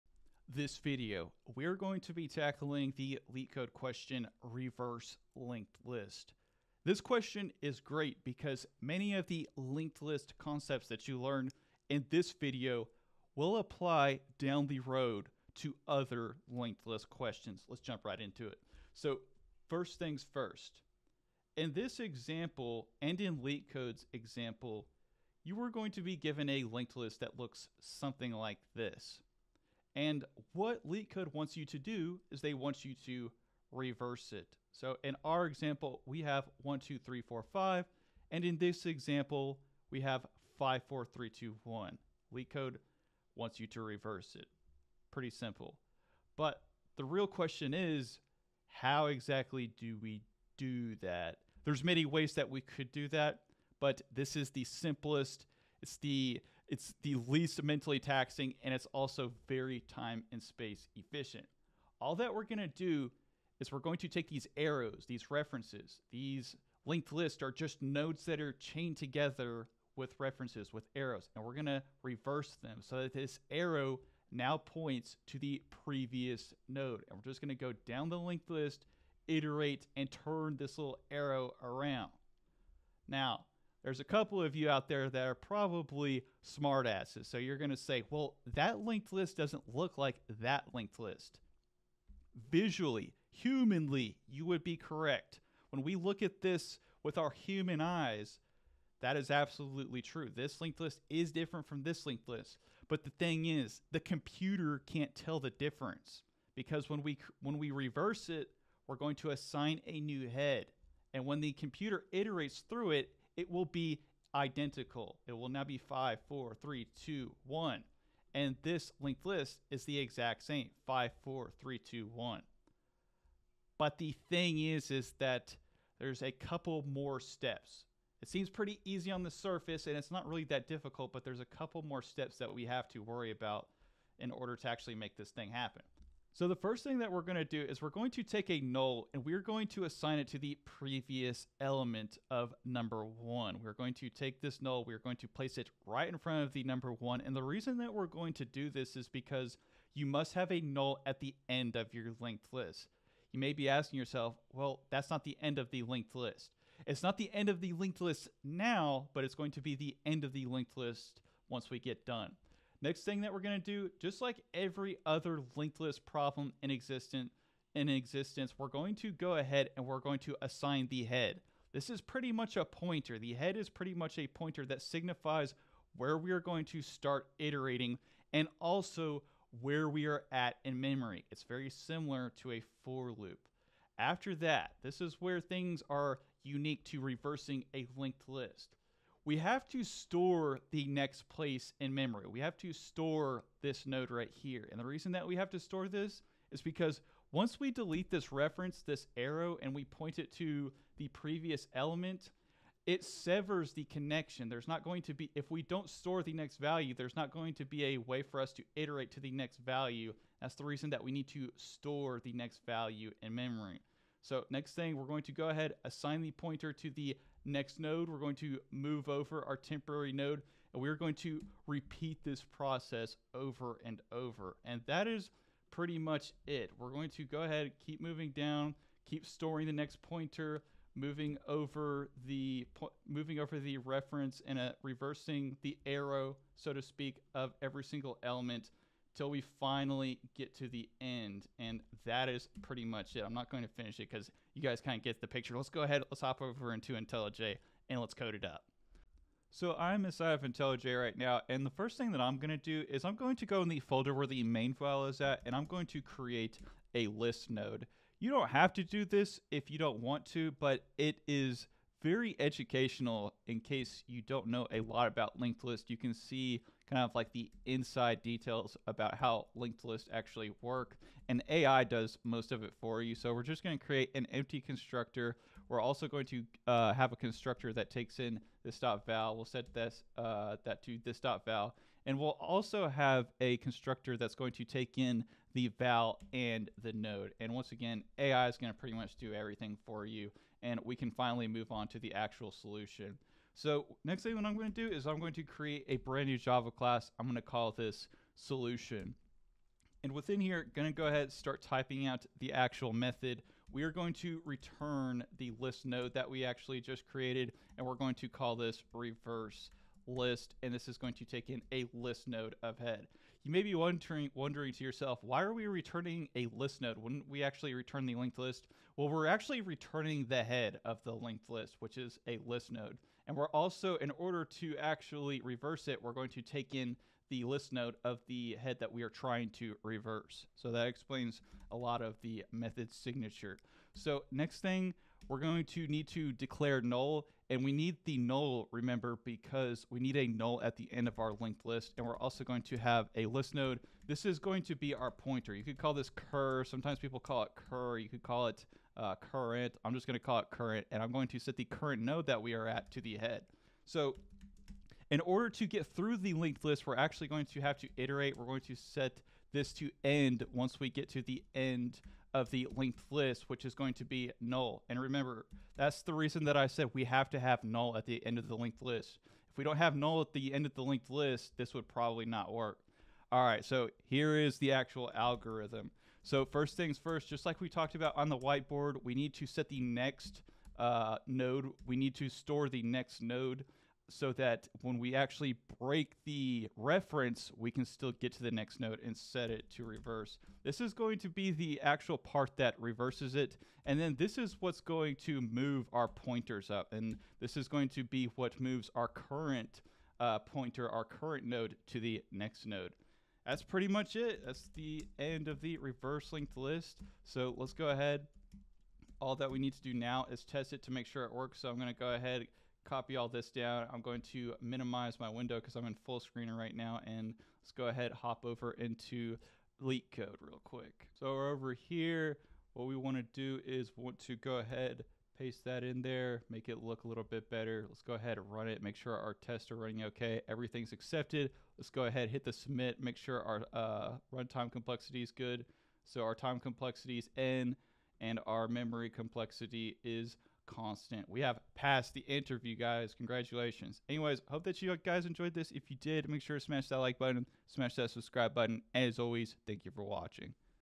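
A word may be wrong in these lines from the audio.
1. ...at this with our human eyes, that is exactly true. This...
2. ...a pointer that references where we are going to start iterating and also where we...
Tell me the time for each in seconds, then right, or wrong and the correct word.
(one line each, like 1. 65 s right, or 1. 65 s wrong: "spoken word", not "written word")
1. 96 s wrong: "absolutely", not "exactly"
2. 174 s wrong: "signifies", not "references".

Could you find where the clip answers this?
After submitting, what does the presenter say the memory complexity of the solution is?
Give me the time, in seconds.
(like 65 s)
440 s.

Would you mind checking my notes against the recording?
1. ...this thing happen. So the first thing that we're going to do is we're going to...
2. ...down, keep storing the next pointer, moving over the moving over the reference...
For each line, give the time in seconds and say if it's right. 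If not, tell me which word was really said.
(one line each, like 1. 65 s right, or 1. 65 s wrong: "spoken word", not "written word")
1. 135 s right
2. 228 s right.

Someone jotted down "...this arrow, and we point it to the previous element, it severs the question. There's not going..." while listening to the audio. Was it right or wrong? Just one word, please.
wrong.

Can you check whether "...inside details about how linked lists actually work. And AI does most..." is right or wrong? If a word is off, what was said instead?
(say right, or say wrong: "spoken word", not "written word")
right.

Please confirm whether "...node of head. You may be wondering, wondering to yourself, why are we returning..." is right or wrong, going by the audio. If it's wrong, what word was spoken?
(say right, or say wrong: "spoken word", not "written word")
right.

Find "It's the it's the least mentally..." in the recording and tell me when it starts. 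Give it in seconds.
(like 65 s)
55 s.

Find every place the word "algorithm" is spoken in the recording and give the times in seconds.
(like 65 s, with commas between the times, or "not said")
375 s.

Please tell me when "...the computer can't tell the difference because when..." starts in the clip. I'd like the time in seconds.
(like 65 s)
103 s.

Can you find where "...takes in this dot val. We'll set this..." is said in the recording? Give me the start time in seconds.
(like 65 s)
277 s.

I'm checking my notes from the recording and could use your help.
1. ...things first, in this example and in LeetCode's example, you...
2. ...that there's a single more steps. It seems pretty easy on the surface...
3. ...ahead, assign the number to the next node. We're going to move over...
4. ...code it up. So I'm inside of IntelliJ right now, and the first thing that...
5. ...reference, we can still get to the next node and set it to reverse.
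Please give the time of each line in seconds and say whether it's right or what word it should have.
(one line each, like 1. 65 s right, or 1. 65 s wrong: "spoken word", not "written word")
1. 19 s right
2. 125 s wrong: "couple", not "single"
3. 215 s wrong: "pointer", not "number"
4. 248 s right
5. 386 s right.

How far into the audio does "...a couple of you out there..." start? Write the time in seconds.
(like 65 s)
83 s.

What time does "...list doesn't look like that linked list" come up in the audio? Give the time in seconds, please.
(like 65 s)
89 s.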